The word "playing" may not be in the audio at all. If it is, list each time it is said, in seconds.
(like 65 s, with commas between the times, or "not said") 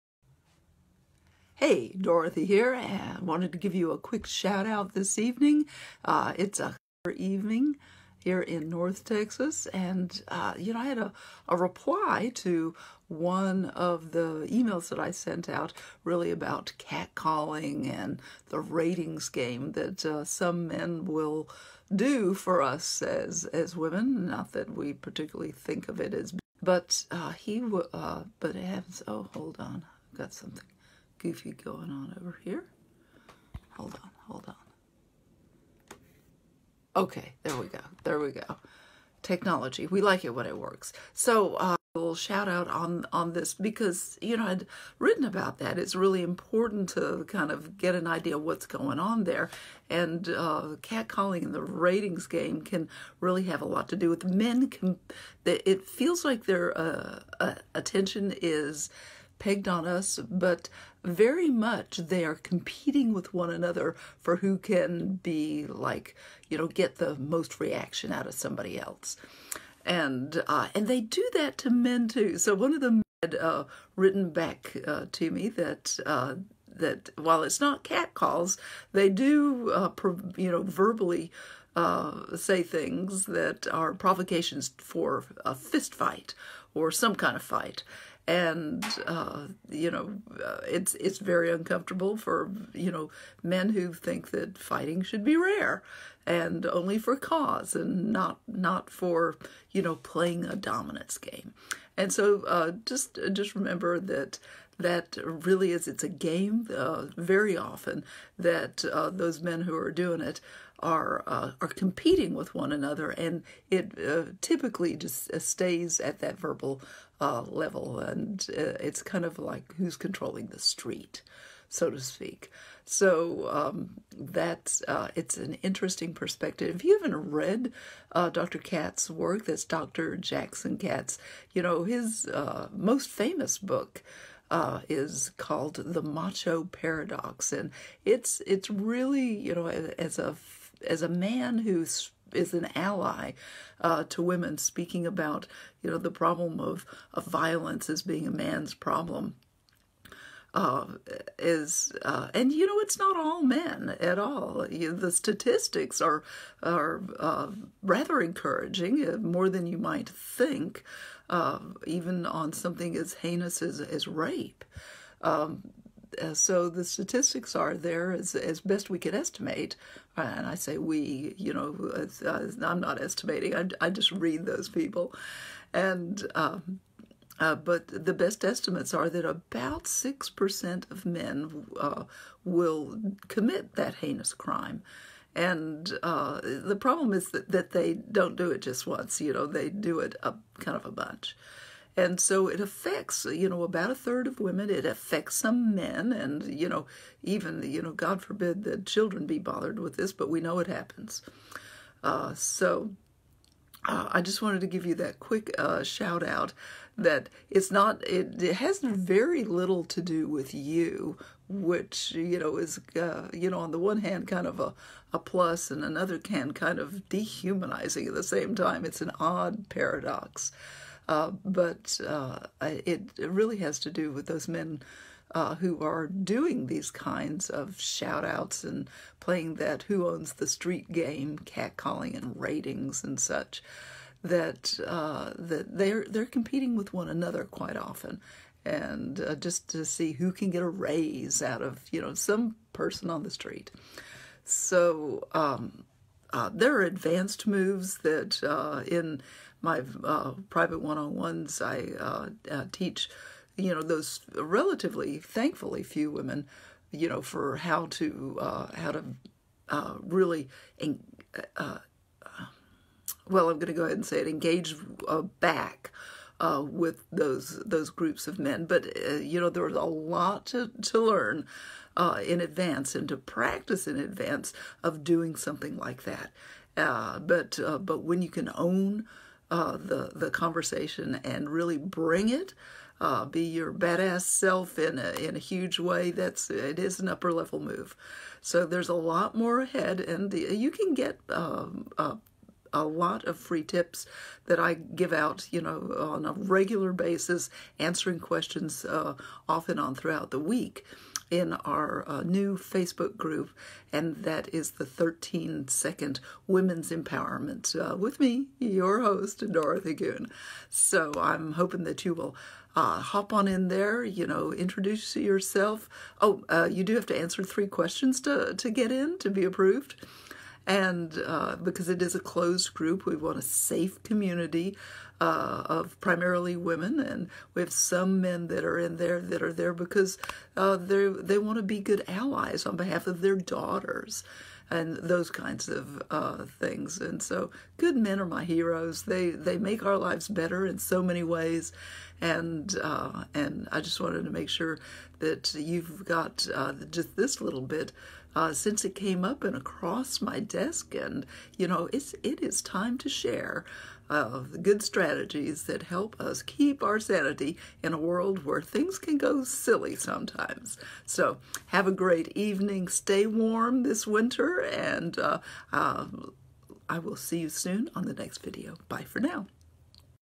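99 s, 229 s.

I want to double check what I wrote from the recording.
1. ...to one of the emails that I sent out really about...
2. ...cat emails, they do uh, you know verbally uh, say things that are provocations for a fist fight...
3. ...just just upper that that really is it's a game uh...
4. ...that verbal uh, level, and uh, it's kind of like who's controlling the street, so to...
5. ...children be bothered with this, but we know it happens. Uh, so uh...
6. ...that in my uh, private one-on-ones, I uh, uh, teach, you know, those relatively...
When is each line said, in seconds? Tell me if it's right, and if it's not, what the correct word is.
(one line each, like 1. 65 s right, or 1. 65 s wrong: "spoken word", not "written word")
1. 12 s right
2. 77 s wrong: "calls", not "emails"
3. 102 s wrong: "remember", not "upper"
4. 116 s right
5. 198 s right
6. 248 s right.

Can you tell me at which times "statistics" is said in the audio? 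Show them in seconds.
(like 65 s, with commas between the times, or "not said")
155 s, 166 s.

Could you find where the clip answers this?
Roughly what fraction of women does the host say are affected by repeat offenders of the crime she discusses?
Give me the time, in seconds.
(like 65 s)
193 s.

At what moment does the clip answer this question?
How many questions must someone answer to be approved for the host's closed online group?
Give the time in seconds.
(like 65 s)
317 s.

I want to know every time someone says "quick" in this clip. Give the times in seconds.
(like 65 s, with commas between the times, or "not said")
3 s, 205 s.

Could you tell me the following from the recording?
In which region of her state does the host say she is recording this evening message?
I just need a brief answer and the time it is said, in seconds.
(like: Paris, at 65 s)
North Texas, at 8 s.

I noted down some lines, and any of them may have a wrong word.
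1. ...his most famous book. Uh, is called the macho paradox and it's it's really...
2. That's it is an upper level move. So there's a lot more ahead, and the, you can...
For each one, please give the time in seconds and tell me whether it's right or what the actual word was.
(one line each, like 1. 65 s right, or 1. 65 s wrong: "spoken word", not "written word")
1. 131 s right
2. 286 s right.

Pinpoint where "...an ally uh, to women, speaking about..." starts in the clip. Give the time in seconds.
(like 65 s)
142 s.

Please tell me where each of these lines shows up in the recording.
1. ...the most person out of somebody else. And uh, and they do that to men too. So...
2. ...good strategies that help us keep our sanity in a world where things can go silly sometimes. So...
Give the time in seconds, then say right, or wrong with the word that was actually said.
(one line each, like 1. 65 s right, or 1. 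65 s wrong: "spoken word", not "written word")
1. 66 s wrong: "reaction", not "person"
2. 354 s right.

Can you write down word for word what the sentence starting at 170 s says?
And I say we, you know, I'm not estimating, I, I just read those people.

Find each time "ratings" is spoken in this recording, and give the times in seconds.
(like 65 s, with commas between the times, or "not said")
18 s, 51 s, 232 s.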